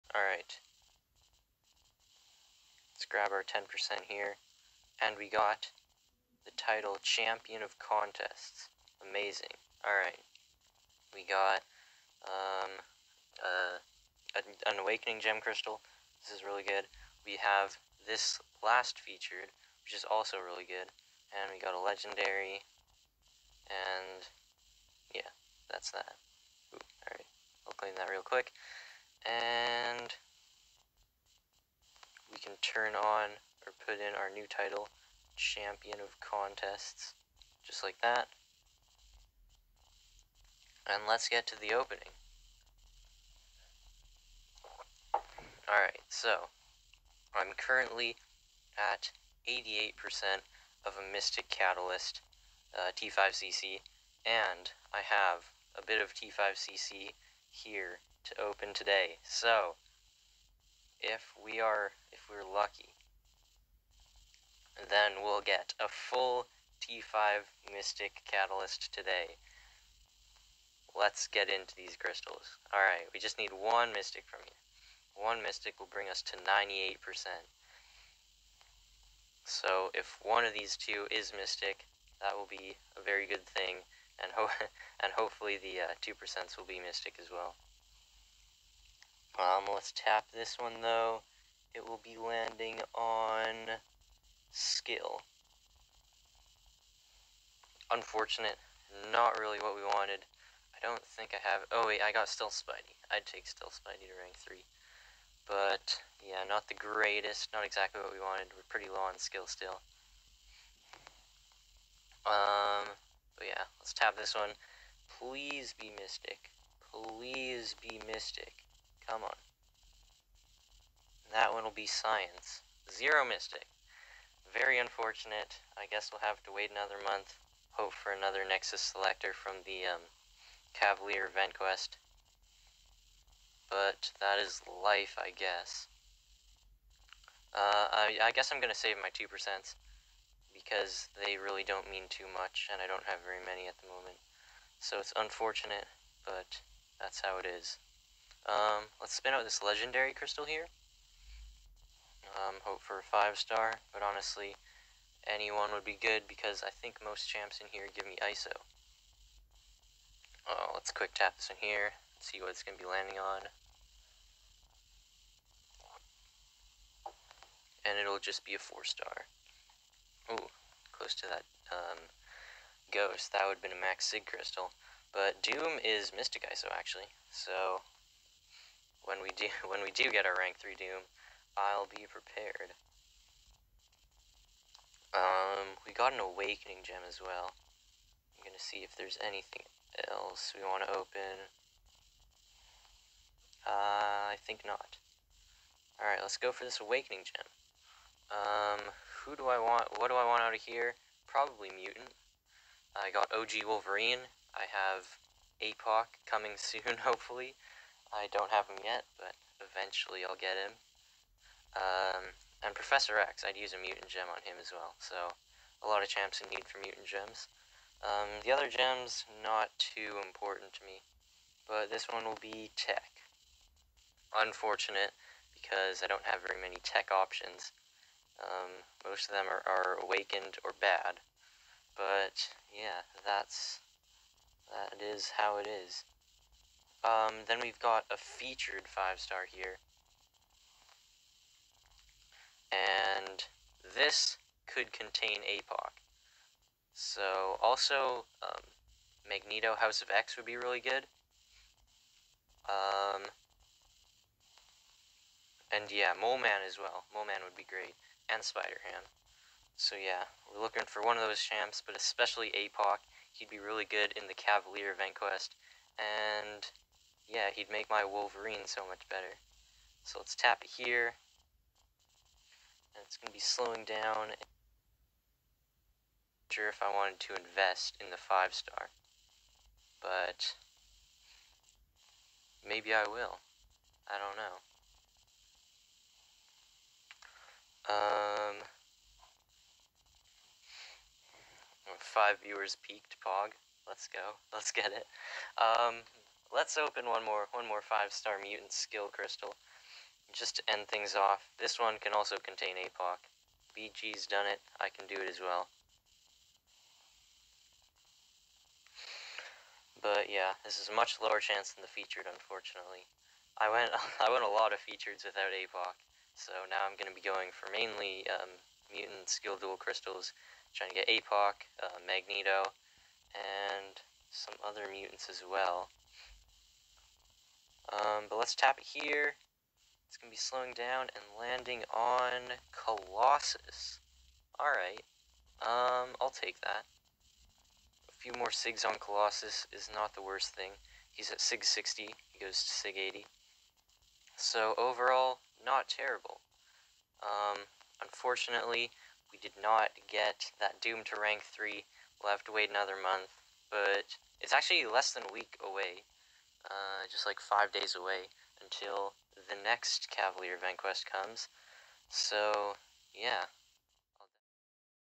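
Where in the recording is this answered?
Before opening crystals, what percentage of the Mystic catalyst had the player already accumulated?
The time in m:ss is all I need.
0:49.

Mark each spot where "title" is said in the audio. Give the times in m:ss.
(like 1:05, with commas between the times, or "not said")
0:06, 0:34.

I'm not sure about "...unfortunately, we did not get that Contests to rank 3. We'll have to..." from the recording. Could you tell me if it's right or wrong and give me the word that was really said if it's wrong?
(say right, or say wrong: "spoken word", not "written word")
wrong: "Doom", not "Contests".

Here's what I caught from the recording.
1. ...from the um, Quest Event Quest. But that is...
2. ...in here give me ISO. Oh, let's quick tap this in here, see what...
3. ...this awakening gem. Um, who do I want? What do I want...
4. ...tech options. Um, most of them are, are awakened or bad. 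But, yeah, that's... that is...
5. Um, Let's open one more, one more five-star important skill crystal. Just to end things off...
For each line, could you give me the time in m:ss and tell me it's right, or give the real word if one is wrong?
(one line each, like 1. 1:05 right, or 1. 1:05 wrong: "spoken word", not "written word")
1. 2:09 wrong: "Cavalier", not "Quest"
2. 2:37 right
3. 3:16 right
4. 3:46 right
5. 4:55 wrong: "mutant", not "important".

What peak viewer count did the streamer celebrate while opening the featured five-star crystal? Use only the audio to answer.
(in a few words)
5.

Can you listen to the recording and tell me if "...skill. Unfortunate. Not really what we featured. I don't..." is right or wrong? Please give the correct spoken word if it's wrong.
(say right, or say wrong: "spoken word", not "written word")
wrong: "wanted", not "featured".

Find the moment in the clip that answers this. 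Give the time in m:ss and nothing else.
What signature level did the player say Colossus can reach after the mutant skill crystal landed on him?
5:42.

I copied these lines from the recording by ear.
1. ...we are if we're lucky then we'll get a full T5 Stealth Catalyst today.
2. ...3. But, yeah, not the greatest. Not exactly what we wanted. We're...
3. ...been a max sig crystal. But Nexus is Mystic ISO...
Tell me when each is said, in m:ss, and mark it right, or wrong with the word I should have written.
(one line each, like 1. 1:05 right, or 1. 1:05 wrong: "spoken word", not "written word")
1. 1:01 wrong: "Mystic", not "Stealth"
2. 1:44 right
3. 2:53 wrong: "Doom", not "Nexus".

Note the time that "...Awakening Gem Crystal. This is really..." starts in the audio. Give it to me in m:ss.
0:14.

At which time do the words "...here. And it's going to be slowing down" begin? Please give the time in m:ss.
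4:30.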